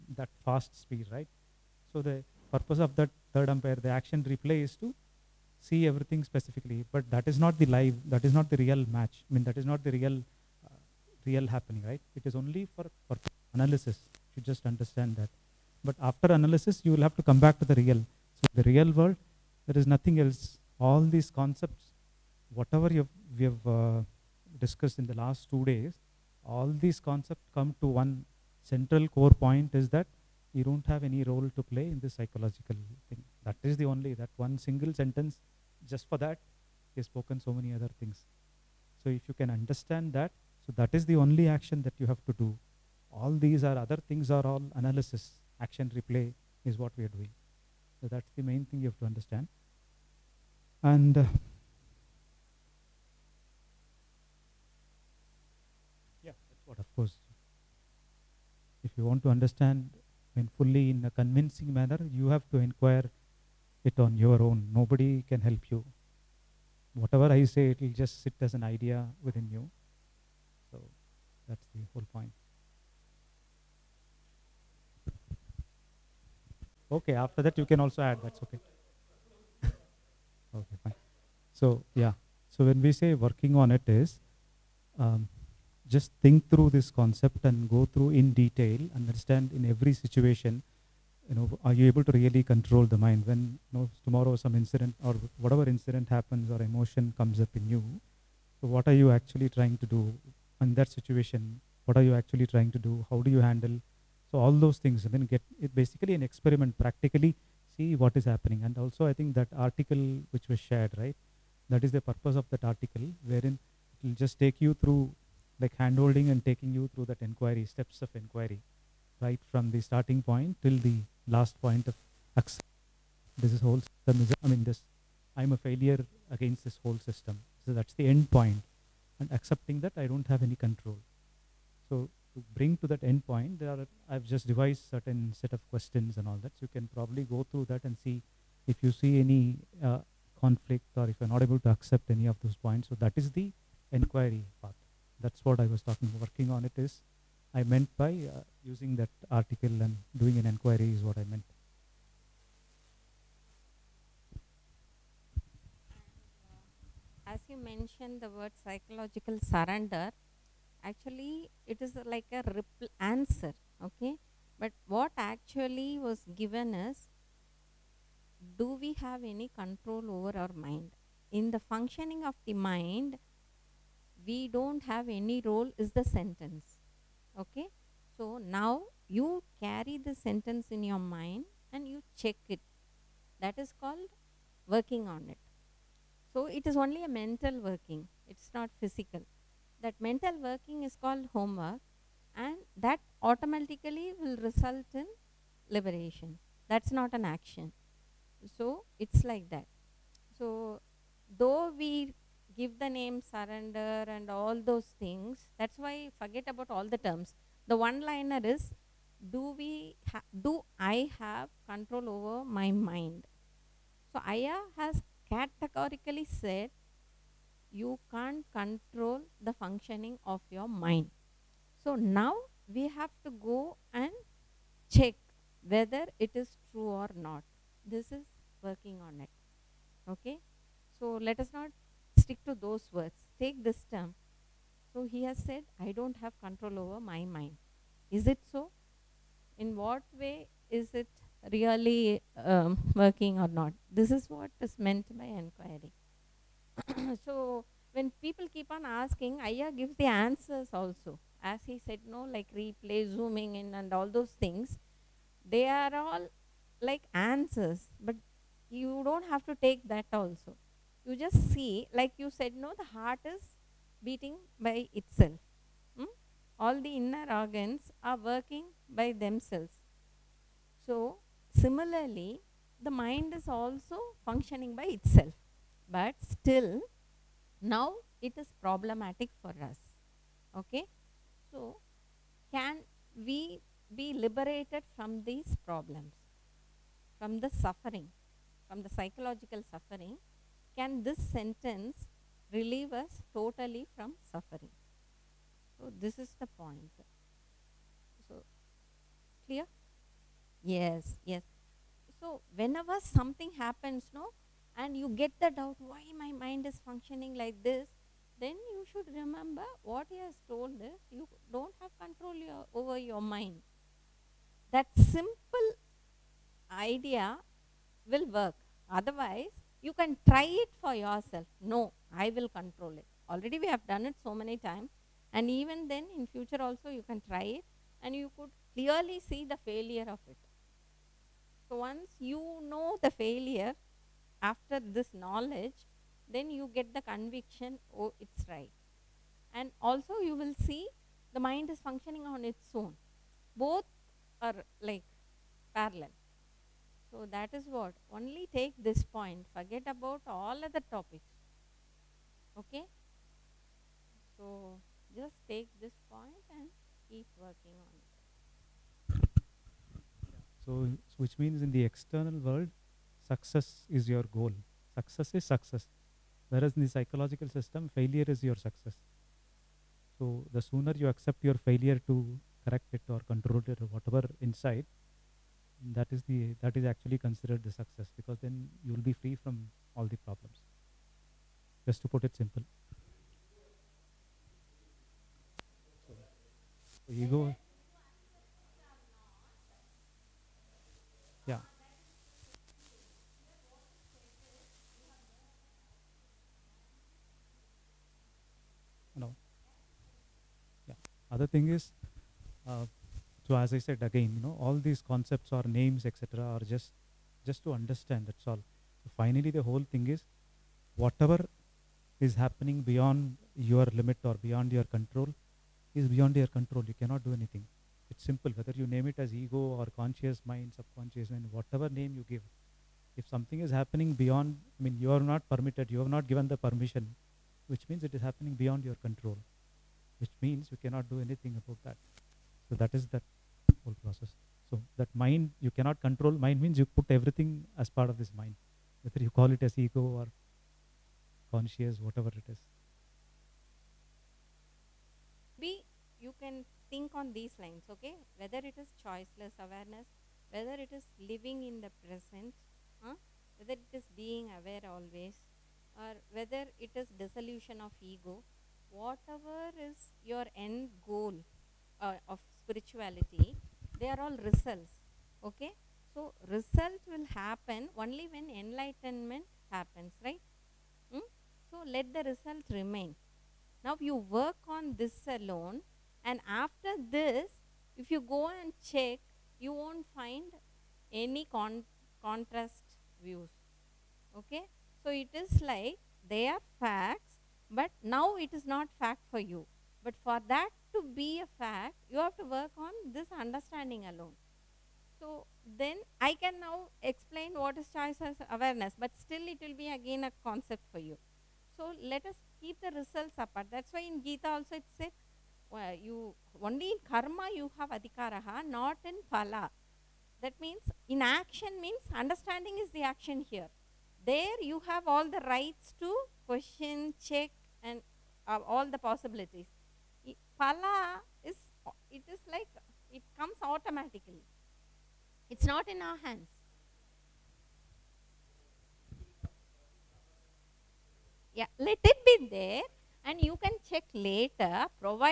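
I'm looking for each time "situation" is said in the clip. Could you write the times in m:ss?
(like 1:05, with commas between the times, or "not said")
1:29, 1:40.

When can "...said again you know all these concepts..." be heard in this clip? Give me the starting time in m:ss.
6:43.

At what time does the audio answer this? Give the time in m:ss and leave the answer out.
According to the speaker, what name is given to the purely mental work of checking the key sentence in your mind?
3:11.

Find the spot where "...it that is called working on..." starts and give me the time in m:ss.
3:02.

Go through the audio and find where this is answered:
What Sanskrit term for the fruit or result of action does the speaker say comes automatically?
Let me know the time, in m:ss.
8:40.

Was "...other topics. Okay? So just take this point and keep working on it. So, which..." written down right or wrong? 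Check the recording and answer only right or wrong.
right.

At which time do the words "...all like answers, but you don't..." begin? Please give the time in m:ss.
4:15.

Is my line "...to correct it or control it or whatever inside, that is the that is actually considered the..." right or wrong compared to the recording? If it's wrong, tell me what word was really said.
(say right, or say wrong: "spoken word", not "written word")
right.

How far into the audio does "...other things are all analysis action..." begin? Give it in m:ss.
0:43.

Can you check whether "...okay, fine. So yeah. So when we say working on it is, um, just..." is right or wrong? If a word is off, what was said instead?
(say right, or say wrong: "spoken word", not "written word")
right.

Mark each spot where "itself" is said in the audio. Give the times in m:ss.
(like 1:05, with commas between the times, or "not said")
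4:24, 4:34.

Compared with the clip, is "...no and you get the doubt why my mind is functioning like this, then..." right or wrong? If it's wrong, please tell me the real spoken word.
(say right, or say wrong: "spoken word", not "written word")
right.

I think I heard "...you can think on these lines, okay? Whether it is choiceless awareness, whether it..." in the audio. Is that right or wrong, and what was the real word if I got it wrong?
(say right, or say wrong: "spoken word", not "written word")
right.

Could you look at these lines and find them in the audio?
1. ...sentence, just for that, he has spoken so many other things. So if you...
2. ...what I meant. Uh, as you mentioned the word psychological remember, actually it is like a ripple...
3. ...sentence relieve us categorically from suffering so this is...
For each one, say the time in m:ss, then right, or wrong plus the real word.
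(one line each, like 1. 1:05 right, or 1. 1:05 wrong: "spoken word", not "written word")
1. 0:34 right
2. 2:31 wrong: "surrender", not "remember"
3. 4:51 wrong: "totally", not "categorically".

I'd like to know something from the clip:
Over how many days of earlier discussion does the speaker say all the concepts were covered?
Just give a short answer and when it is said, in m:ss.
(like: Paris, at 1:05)
2, at 0:25.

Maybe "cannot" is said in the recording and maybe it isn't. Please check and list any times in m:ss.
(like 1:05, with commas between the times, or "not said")
6:57, 7:10, 7:15.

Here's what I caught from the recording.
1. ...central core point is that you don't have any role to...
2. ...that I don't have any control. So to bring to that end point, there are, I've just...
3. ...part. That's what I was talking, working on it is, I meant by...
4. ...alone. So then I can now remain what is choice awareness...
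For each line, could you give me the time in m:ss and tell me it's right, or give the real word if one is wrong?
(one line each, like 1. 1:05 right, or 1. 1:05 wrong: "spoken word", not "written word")
1. 0:28 right
2. 2:09 right
3. 2:24 right
4. 8:14 wrong: "explain", not "remain".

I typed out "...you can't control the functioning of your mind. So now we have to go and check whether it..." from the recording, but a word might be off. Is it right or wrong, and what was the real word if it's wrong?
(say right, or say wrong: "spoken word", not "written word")
right.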